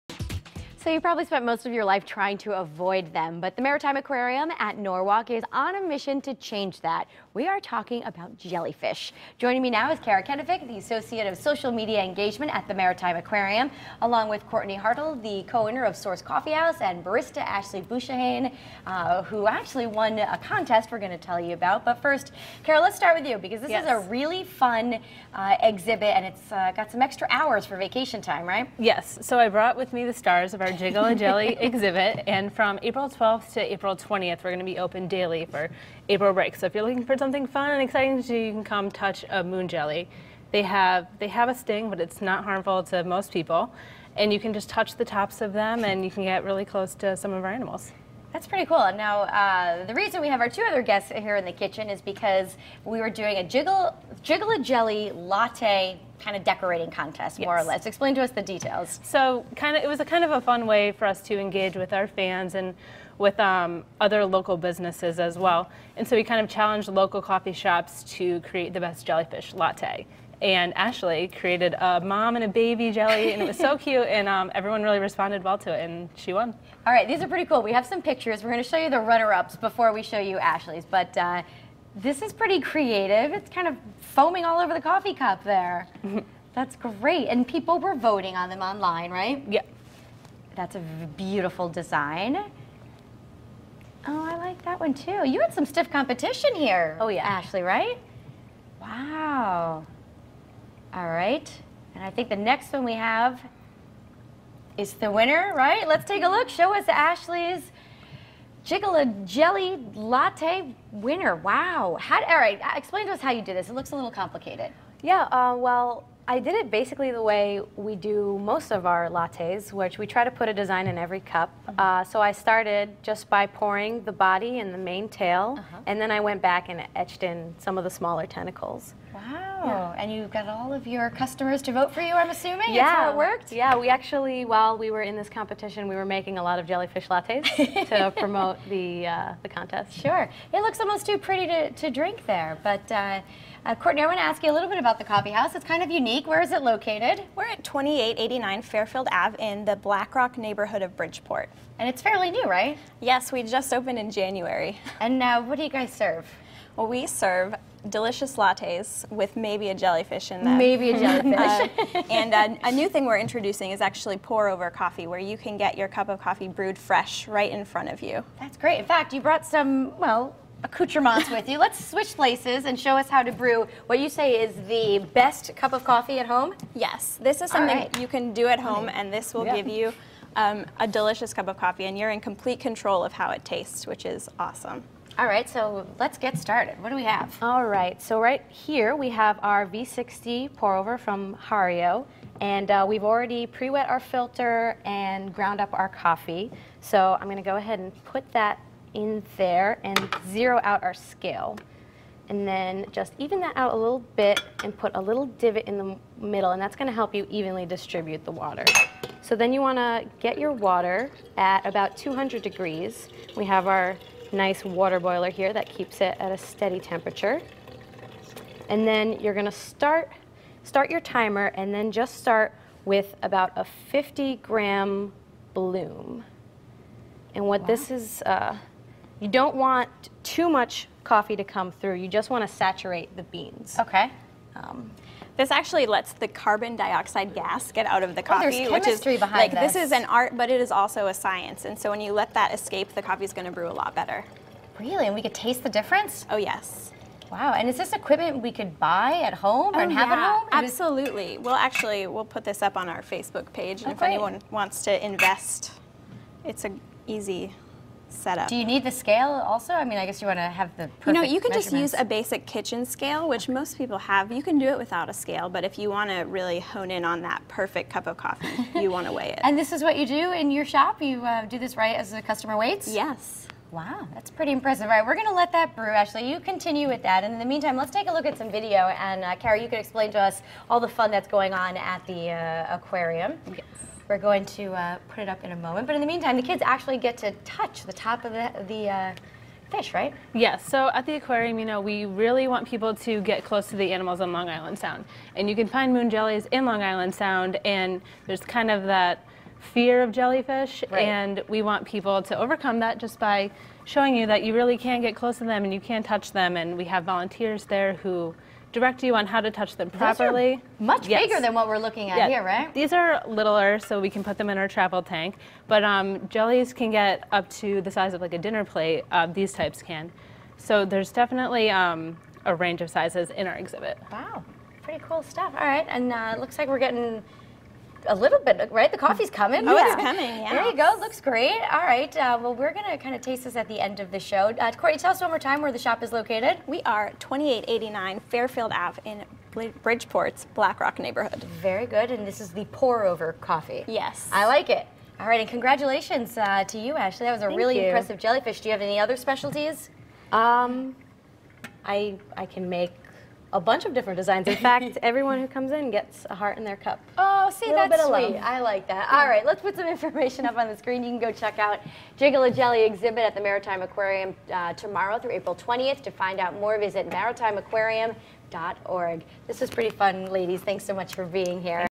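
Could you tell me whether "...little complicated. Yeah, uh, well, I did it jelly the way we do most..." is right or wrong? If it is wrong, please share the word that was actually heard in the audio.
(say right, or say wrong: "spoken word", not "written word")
wrong: "basically", not "jelly".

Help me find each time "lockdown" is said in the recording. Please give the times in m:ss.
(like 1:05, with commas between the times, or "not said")
not said.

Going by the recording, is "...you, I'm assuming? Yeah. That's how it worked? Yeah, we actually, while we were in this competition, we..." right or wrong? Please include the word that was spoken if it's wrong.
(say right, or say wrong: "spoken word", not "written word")
right.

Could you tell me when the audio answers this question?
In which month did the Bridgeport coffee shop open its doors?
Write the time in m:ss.
2:34.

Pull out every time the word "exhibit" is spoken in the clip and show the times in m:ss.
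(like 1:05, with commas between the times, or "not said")
0:25, 0:31, 5:23, 6:02.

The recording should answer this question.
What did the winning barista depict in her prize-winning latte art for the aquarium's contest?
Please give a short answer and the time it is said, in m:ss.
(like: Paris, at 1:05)
A mom and a baby jelly, at 1:11.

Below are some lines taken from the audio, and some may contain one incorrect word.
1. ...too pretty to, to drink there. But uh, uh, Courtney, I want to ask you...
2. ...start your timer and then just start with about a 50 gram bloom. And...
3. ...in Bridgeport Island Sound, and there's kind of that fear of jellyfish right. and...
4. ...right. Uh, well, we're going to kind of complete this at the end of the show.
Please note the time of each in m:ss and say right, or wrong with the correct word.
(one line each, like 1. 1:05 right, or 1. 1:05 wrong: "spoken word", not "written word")
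1. 2:21 right
2. 3:40 right
3. 4:56 wrong: "Long", not "Bridgeport"
4. 5:31 wrong: "taste", not "complete".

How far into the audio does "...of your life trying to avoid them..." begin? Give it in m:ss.
0:01.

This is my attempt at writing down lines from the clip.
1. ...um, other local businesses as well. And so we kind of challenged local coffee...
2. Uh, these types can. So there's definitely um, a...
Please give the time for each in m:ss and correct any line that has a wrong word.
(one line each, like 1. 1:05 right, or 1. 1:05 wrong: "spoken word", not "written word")
1. 1:03 right
2. 5:19 right.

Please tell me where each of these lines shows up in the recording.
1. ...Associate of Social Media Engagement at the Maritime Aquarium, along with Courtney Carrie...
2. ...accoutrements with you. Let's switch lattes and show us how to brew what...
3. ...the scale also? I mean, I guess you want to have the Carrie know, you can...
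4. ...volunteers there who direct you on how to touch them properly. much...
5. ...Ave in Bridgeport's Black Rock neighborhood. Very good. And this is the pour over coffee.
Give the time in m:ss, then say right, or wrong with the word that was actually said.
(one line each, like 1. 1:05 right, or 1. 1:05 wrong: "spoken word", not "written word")
1. 0:10 wrong: "Hartle", not "Carrie"
2. 2:50 wrong: "places", not "lattes"
3. 4:18 wrong: "You", not "Carrie"
4. 5:07 right
5. 5:38 right.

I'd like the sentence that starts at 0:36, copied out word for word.
So if you're looking for something fun and exciting to do, you can come touch a moon jelly.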